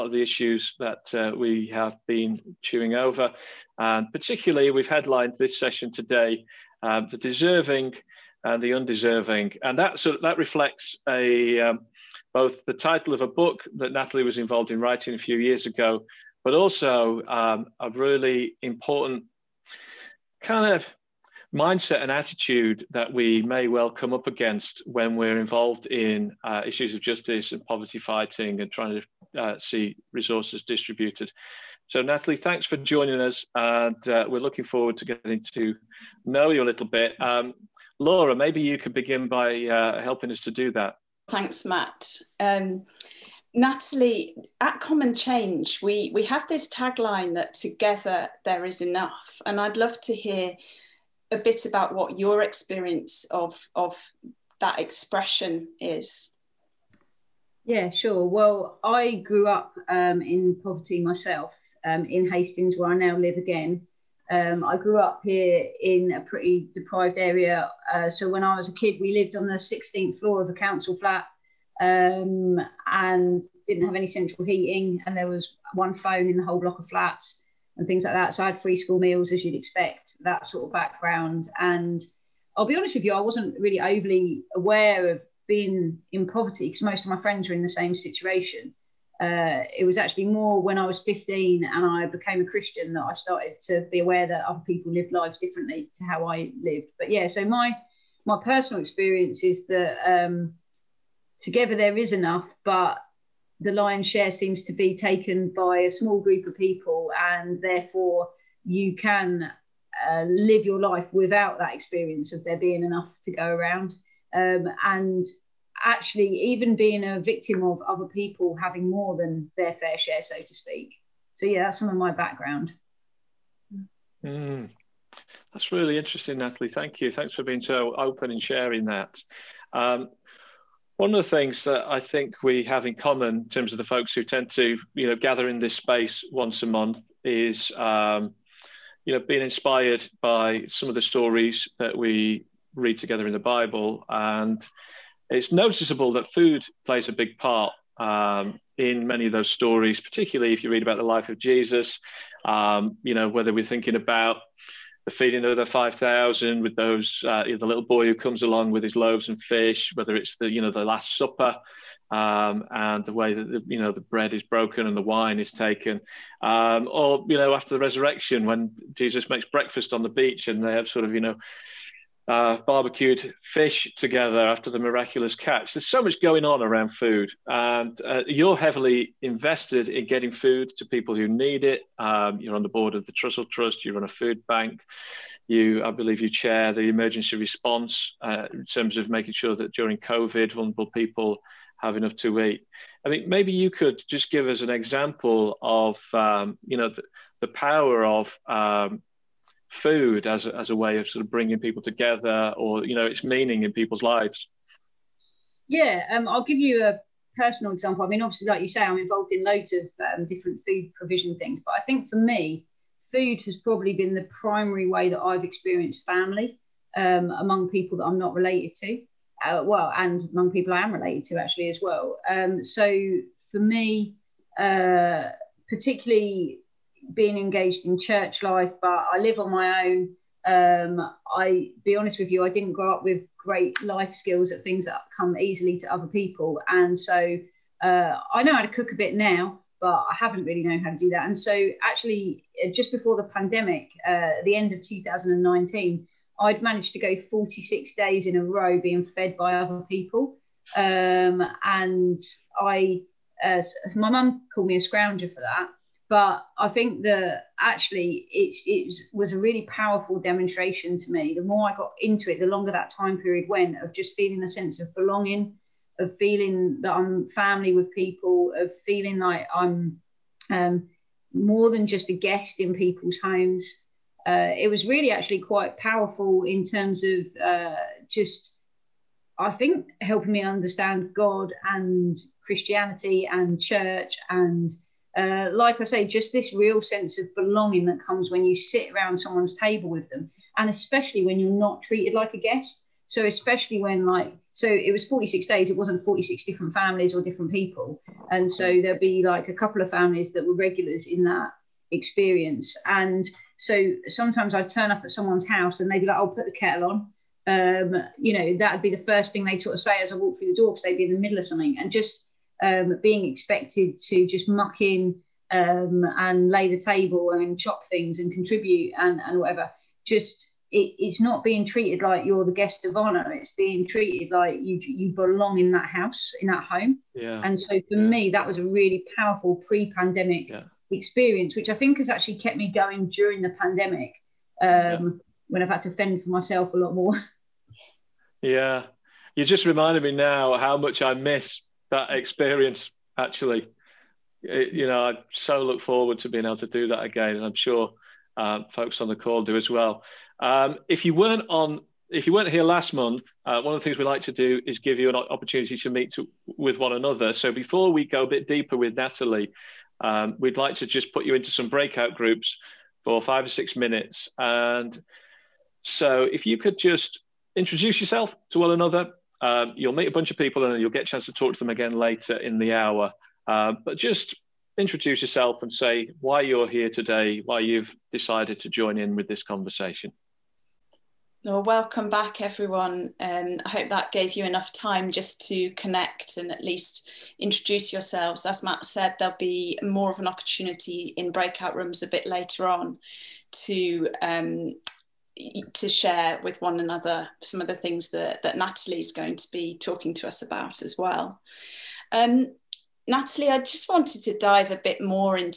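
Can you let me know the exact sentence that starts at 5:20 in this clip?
Just it, it's not being treated like you're the guest of honor.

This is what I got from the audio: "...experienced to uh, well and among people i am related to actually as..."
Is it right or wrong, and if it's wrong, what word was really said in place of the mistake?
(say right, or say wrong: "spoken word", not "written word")
wrong: "related", not "experienced".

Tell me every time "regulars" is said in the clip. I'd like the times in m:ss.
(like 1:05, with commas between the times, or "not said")
5:00.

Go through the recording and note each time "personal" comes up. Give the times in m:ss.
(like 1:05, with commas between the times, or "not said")
1:38, 3:27.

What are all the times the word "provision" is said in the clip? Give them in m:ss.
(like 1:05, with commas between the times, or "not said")
3:30.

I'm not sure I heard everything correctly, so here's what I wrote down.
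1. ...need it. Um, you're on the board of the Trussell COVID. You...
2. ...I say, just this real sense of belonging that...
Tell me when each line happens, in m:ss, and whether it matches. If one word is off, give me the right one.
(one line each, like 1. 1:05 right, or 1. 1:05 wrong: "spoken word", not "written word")
1. 3:01 wrong: "Trust", not "COVID"
2. 4:45 right.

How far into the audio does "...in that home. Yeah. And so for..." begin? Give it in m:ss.
5:26.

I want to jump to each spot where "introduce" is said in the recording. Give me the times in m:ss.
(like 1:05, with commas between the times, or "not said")
6:07, 6:14, 6:27.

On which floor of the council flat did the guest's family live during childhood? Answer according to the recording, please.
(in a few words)
16th.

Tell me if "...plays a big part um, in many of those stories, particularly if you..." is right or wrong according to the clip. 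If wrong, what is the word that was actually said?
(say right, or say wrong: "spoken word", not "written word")
right.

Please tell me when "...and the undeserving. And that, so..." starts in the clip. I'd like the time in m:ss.
0:08.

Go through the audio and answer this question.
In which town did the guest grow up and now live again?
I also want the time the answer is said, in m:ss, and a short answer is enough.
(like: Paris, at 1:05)
Hastings, at 1:02.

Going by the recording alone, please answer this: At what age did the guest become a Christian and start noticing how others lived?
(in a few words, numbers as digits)
15.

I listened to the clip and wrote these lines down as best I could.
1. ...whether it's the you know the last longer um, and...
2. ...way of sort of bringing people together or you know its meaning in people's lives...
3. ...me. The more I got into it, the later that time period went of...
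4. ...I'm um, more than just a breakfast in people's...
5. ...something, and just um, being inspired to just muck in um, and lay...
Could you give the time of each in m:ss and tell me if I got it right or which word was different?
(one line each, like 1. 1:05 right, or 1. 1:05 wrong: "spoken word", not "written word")
1. 2:39 wrong: "supper", not "longer"
2. 3:20 right
3. 4:21 wrong: "longer", not "later"
4. 4:29 wrong: "guest", not "breakfast"
5. 5:11 wrong: "expected", not "inspired".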